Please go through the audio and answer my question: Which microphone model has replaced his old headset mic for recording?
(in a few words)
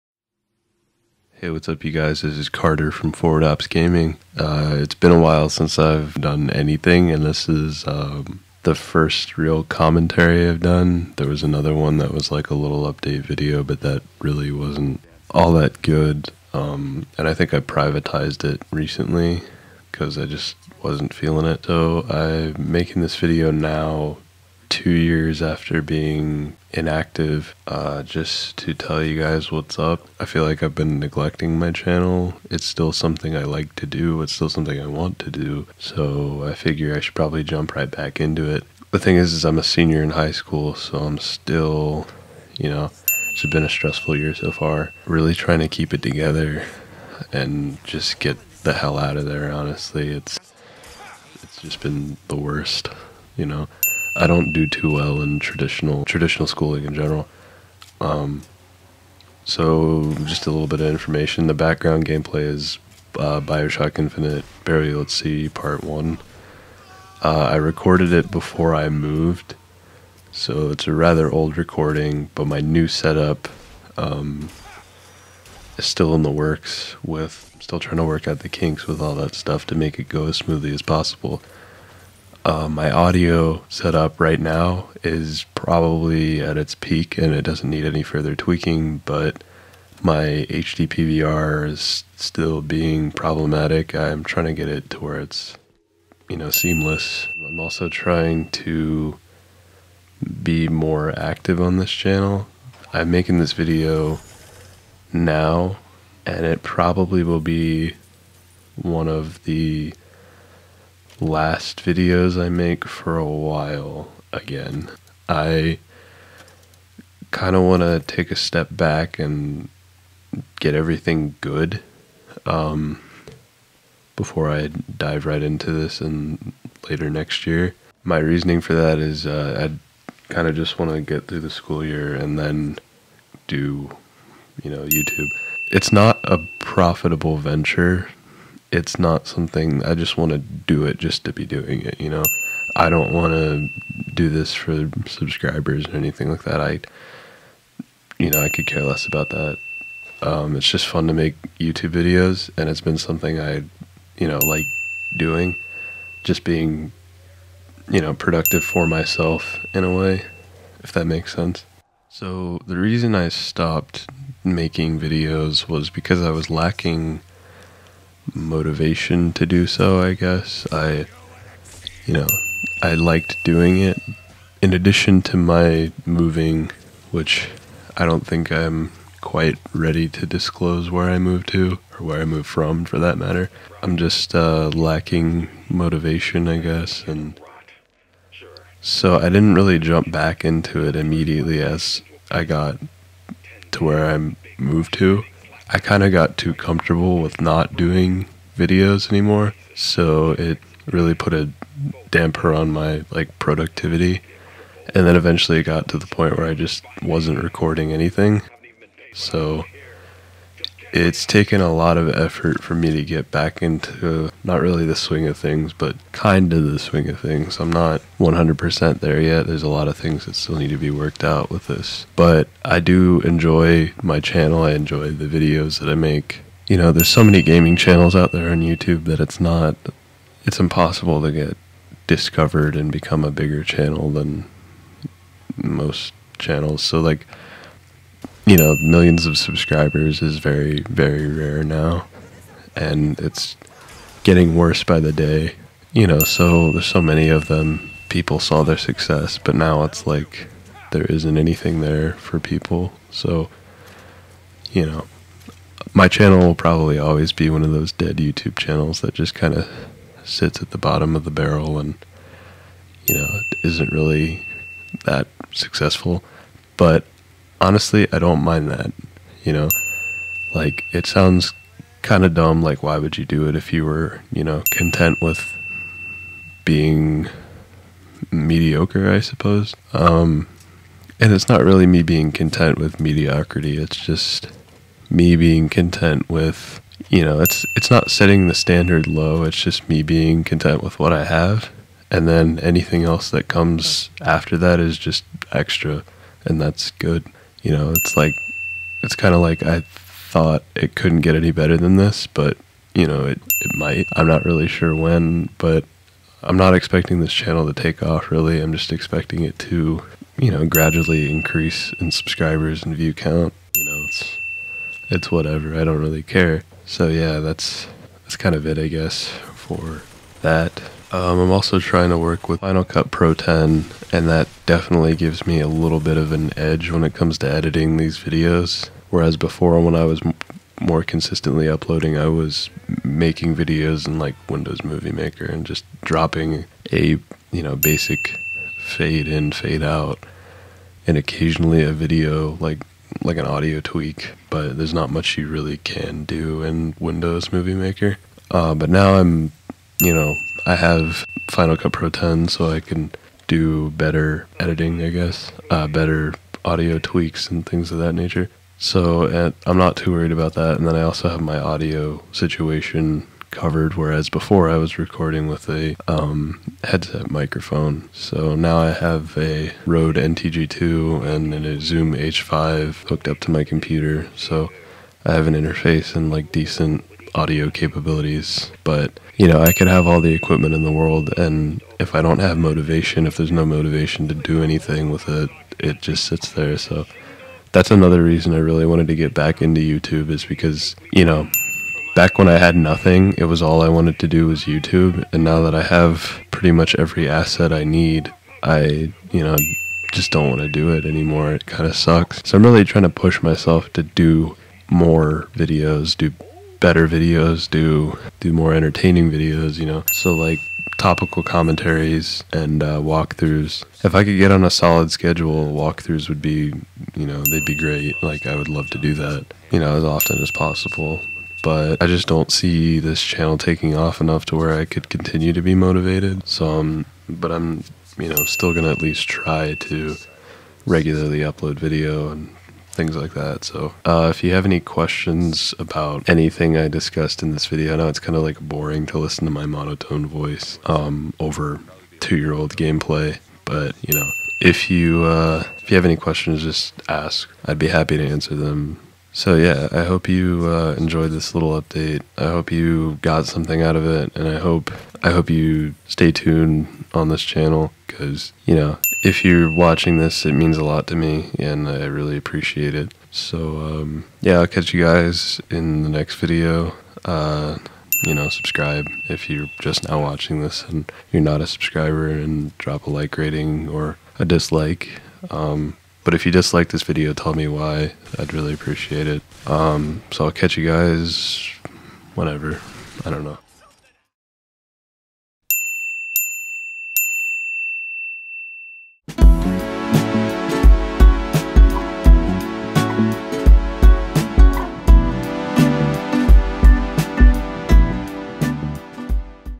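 Rode NTG2.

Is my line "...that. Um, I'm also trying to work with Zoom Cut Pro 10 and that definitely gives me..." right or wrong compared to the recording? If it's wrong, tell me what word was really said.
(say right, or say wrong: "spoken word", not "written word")
wrong: "Final", not "Zoom".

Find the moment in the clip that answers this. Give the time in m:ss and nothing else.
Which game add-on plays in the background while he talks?
1:03.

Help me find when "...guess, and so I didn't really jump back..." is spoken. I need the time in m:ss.
3:06.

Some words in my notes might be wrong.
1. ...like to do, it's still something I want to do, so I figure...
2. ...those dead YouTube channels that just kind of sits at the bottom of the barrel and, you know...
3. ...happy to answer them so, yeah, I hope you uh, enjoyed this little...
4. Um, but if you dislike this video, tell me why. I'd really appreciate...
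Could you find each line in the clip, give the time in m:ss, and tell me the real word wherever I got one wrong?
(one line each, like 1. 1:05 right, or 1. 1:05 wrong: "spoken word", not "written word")
1. 0:33 right
2. 4:17 right
3. 7:27 right
4. 7:55 right.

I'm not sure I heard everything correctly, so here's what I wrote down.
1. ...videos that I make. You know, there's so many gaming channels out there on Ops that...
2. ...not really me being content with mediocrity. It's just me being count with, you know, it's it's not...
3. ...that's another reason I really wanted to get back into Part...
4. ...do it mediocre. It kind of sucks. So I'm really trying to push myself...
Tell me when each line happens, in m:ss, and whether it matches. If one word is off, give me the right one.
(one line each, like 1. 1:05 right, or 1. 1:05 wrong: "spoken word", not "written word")
1. 3:45 wrong: "YouTube", not "Ops"
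2. 4:41 wrong: "content", not "count"
3. 6:27 wrong: "YouTube", not "Part"
4. 6:40 wrong: "anymore", not "mediocre".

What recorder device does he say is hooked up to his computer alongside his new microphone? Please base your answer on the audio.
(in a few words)
Zoom H5.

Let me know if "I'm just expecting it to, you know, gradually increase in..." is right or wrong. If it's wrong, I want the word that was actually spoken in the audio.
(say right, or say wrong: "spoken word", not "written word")
right.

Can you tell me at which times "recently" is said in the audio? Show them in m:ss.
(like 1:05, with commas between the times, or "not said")
0:18.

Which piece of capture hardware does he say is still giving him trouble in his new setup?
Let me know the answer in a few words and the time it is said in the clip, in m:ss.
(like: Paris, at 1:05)
HD PVR, at 1:30.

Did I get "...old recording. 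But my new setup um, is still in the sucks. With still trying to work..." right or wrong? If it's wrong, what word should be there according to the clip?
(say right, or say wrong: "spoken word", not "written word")
wrong: "works", not "sucks".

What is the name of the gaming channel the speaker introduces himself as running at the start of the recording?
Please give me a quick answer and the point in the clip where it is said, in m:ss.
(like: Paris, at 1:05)
Forward Ops Gaming, at 0:03.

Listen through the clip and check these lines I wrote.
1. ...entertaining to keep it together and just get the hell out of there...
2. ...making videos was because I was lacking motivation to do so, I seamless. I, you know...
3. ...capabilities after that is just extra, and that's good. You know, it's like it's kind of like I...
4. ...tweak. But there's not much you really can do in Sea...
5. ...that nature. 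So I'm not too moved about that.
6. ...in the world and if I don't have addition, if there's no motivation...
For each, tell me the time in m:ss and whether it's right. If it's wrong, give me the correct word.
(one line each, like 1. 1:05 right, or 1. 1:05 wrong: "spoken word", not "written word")
1. 0:45 wrong: "trying", not "entertaining"
2. 2:44 wrong: "guess", not "seamless"
3. 4:53 wrong: "comes", not "capabilities"
4. 5:43 wrong: "Windows", not "Sea"
5. 5:57 wrong: "worried", not "moved"
6. 6:20 wrong: "motivation", not "addition".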